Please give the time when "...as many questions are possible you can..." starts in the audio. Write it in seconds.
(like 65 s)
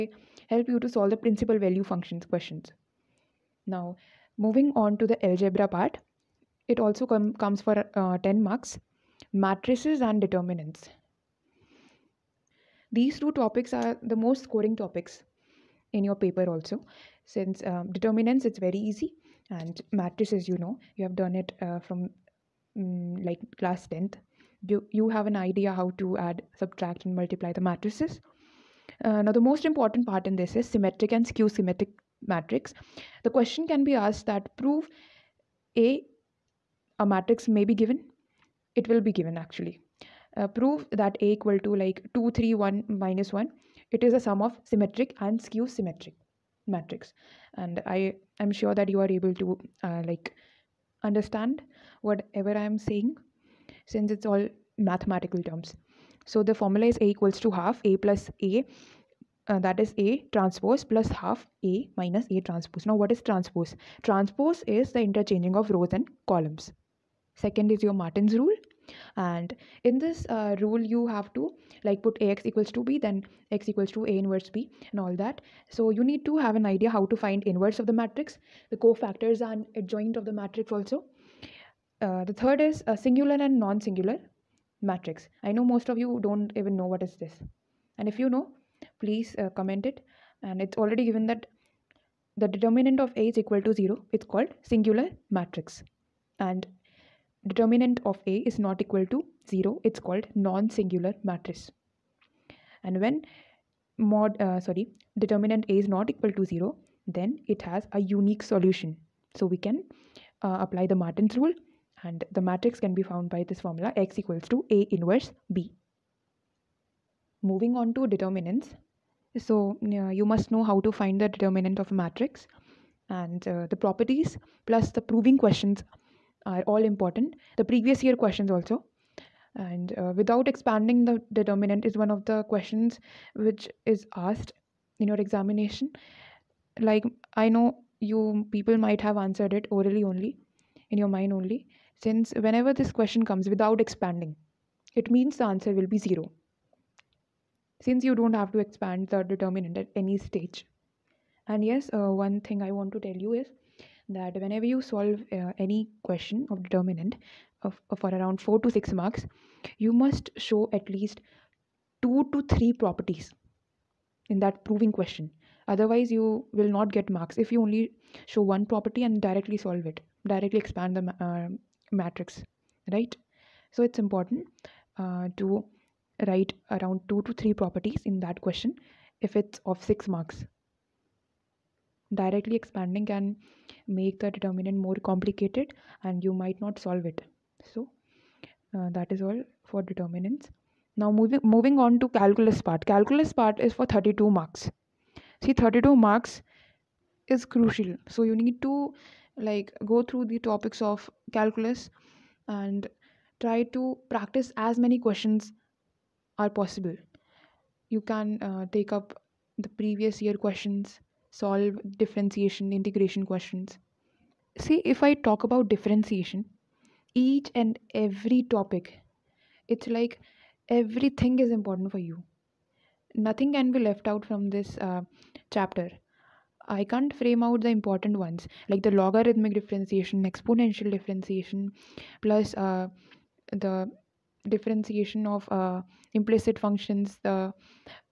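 204 s.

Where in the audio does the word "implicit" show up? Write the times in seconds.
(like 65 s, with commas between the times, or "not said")
236 s.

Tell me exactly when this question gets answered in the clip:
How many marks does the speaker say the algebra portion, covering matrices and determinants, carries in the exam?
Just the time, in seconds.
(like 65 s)
8 s.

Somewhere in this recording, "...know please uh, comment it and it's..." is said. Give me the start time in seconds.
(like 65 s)
88 s.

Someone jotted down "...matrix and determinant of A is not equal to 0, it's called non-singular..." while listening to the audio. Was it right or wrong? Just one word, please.
right.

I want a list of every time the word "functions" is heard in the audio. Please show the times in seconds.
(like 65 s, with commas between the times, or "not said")
1 s, 236 s.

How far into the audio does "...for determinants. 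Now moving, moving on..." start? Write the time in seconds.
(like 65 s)
189 s.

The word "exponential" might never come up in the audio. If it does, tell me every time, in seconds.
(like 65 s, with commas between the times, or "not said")
230 s.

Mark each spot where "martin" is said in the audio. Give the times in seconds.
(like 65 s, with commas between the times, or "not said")
68 s, 110 s.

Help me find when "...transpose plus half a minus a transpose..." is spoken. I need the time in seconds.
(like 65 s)
60 s.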